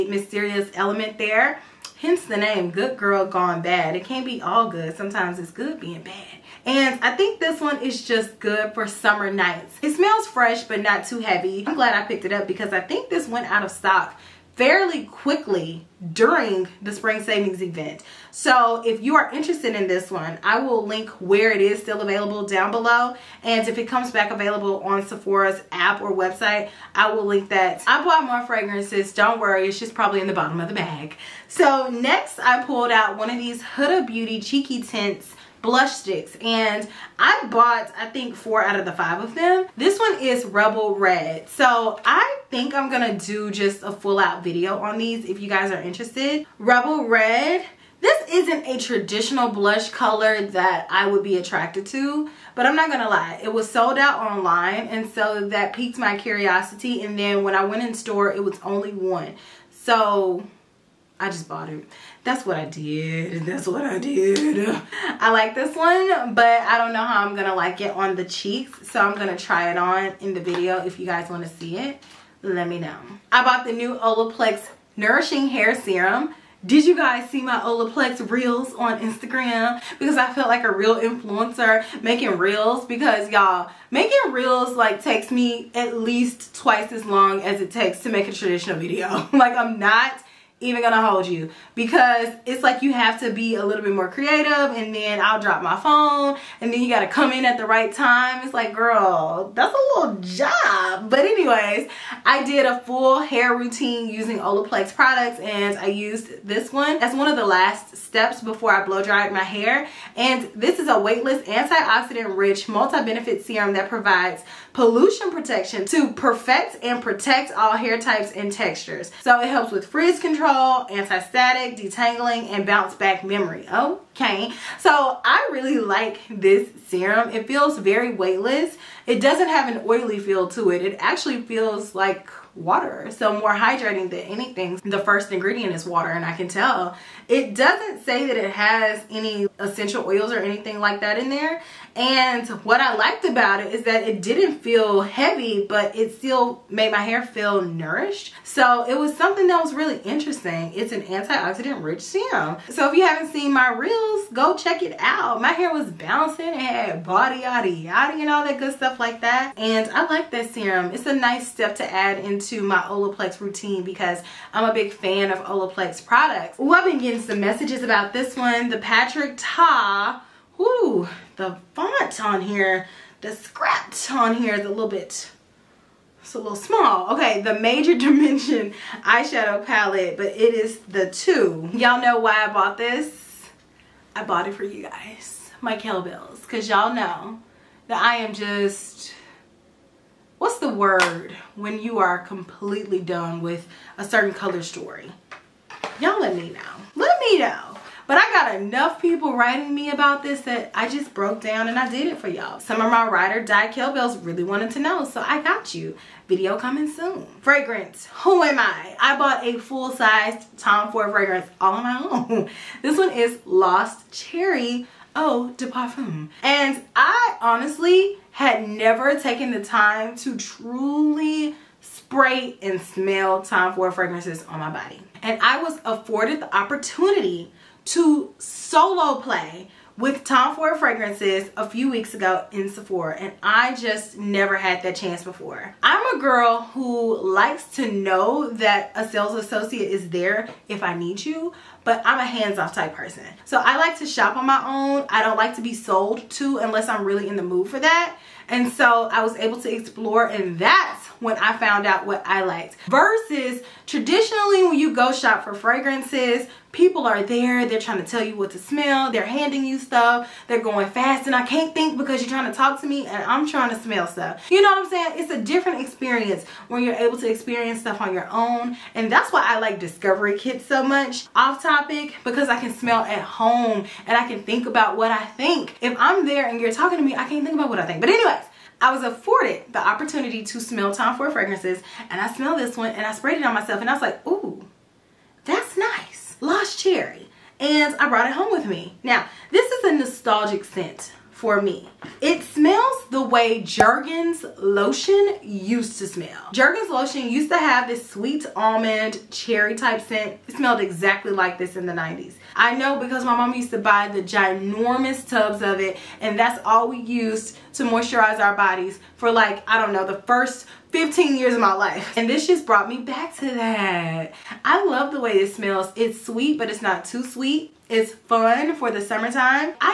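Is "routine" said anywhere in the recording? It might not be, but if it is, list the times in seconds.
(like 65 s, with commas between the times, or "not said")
103 s, 163 s.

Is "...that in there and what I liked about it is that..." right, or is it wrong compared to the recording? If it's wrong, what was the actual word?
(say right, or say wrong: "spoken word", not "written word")
right.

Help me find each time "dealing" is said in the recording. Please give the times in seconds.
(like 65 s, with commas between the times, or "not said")
not said.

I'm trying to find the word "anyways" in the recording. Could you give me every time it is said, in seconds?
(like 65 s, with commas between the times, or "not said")
101 s, 278 s.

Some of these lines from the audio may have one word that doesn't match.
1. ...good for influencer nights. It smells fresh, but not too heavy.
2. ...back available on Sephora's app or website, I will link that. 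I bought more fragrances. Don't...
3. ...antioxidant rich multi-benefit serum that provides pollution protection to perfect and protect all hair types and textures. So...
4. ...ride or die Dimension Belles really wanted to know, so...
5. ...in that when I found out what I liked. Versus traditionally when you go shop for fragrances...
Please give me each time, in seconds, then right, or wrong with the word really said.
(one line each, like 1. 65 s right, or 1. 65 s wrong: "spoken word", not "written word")
1. 8 s wrong: "summer", not "influencer"
2. 24 s right
3. 111 s right
4. 203 s wrong: "Kel", not "Dimension"
5. 250 s right.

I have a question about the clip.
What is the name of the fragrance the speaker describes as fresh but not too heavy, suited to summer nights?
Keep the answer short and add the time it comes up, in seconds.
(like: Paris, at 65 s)
Good Girl Gone Bad, at 2 s.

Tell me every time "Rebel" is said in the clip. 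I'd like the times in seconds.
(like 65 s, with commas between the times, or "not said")
40 s, 46 s.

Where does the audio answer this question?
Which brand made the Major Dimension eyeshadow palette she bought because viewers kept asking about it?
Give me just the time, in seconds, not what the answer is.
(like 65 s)
168 s.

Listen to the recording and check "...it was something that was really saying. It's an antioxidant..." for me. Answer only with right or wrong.
wrong.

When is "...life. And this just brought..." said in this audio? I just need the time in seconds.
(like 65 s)
311 s.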